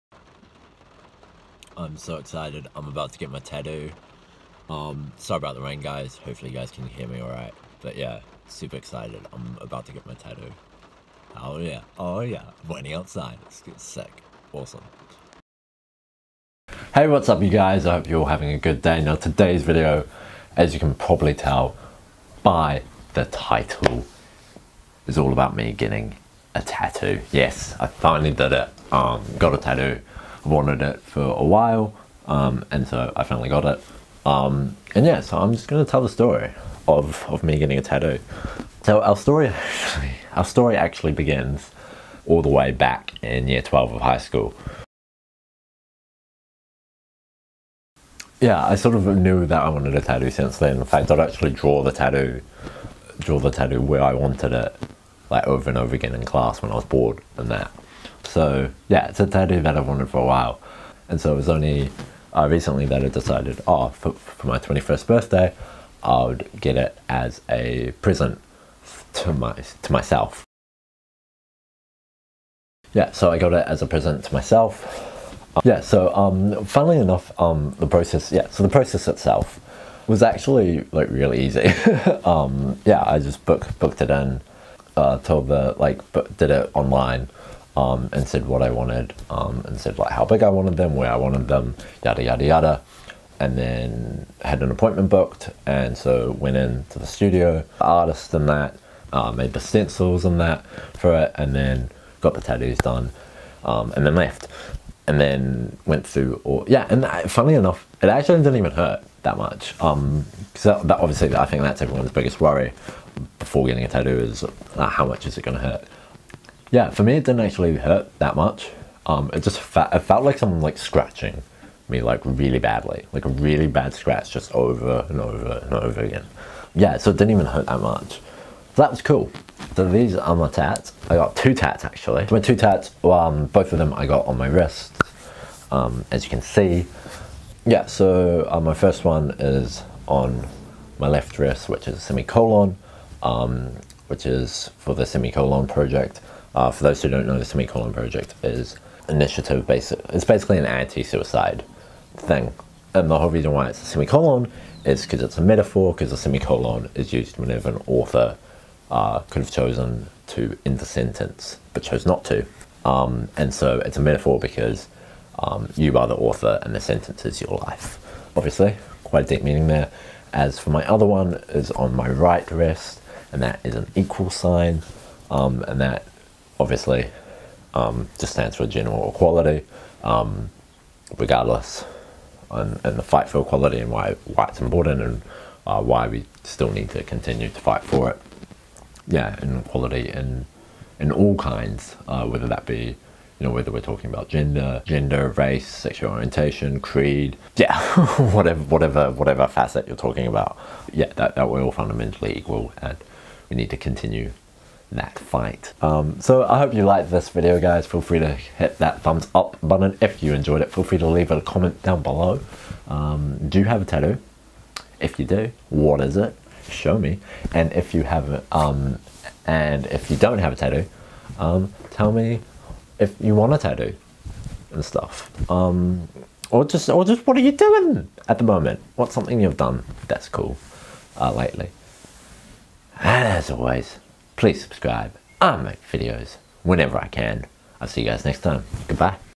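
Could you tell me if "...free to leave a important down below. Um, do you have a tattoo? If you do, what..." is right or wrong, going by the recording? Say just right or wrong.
wrong.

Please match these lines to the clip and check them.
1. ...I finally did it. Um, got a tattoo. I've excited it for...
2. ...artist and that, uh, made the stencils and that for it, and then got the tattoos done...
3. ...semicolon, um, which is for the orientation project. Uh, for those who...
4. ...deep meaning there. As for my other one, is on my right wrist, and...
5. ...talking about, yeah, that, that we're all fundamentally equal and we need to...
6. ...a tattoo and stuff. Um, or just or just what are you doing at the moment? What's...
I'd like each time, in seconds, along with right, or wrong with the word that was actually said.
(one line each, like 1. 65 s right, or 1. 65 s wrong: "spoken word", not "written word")
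1. 27 s wrong: "wanted", not "excited"
2. 97 s right
3. 141 s wrong: "semicolon", not "orientation"
4. 169 s right
5. 199 s right
6. 223 s right.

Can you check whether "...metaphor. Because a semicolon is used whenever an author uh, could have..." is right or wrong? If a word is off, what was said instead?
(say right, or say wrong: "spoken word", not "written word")
right.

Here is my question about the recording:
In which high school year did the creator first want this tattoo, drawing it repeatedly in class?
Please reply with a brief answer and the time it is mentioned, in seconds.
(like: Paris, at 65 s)
Year 12, at 43 s.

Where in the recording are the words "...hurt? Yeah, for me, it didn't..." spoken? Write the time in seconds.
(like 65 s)
115 s.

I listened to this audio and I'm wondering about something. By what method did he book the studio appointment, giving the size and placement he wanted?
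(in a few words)
Online.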